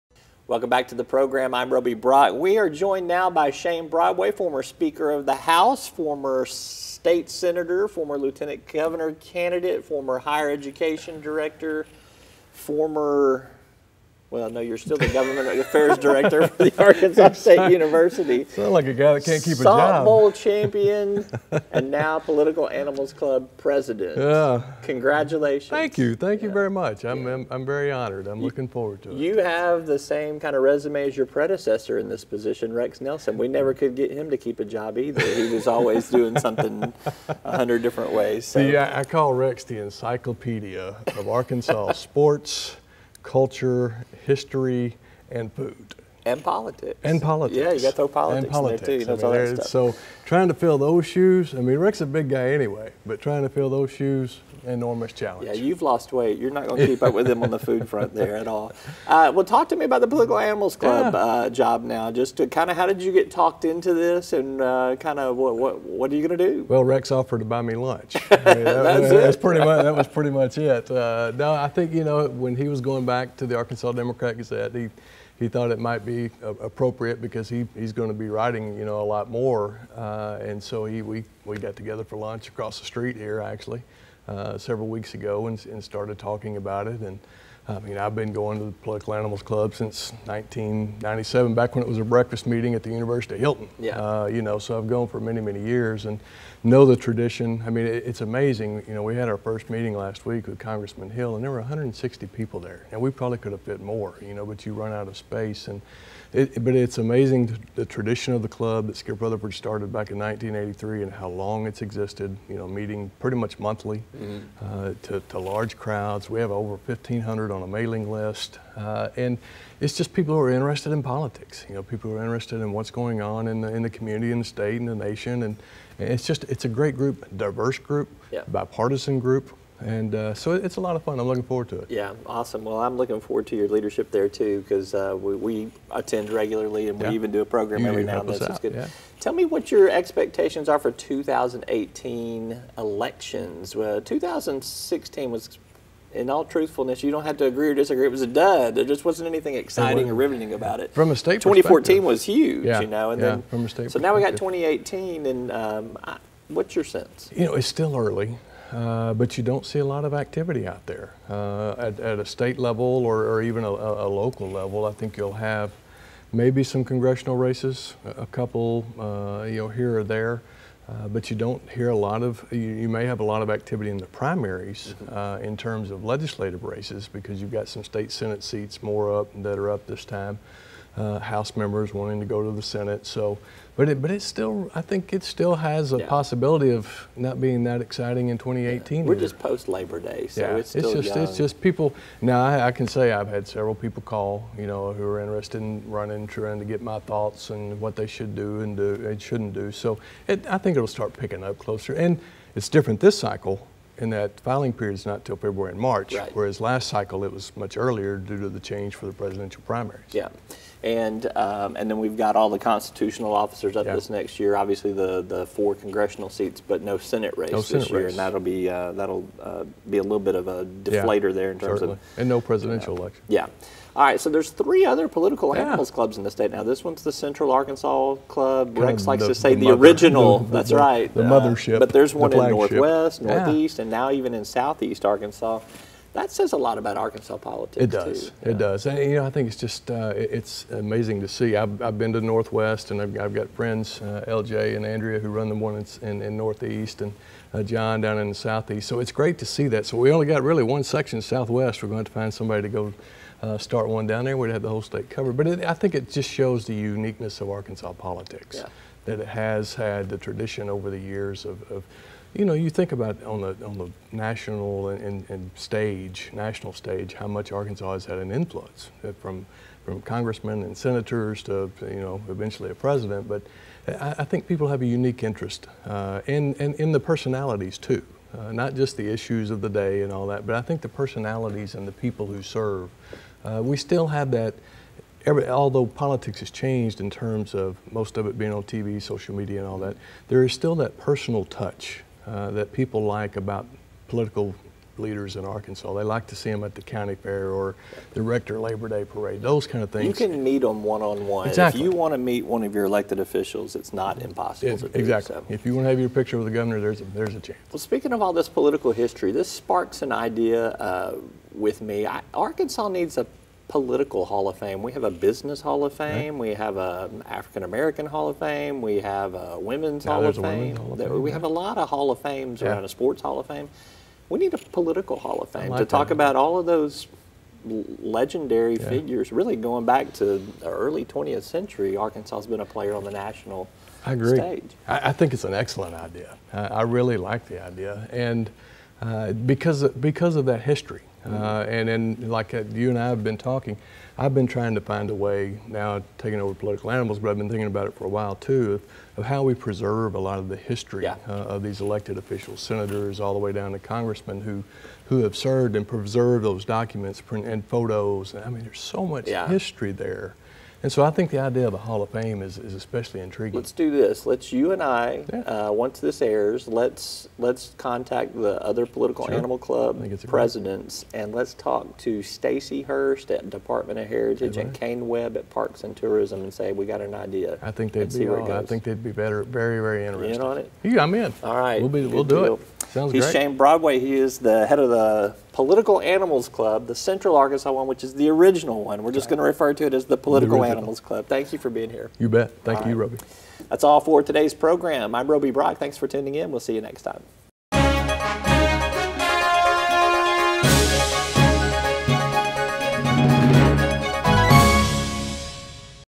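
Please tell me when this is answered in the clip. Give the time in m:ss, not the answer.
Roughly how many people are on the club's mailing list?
1:56.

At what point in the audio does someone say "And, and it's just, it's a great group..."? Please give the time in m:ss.
2:05.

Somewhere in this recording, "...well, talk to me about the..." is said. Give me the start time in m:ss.
0:59.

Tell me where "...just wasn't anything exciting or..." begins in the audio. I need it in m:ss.
2:28.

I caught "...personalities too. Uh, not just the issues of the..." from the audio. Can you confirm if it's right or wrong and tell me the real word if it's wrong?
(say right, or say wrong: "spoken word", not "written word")
right.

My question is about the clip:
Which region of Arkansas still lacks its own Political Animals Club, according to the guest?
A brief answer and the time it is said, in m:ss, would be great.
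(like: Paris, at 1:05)
Southwest, at 4:11.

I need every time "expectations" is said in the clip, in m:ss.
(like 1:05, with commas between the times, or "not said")
2:19.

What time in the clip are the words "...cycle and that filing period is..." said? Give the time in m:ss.
3:23.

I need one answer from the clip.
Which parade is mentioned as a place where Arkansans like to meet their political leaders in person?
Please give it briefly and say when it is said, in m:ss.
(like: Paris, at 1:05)
Rector Labor Day parade, at 4:58.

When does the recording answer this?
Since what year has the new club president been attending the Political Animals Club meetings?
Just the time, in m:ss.
1:30.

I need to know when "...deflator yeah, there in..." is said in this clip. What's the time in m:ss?
3:40.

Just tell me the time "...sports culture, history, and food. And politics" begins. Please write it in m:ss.
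0:41.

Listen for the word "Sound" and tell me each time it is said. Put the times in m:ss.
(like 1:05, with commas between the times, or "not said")
0:18, 6:22.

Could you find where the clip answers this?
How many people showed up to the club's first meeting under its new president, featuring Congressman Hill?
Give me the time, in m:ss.
1:41.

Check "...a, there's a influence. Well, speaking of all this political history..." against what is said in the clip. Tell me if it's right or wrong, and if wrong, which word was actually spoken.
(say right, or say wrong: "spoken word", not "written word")
wrong: "chance", not "influence".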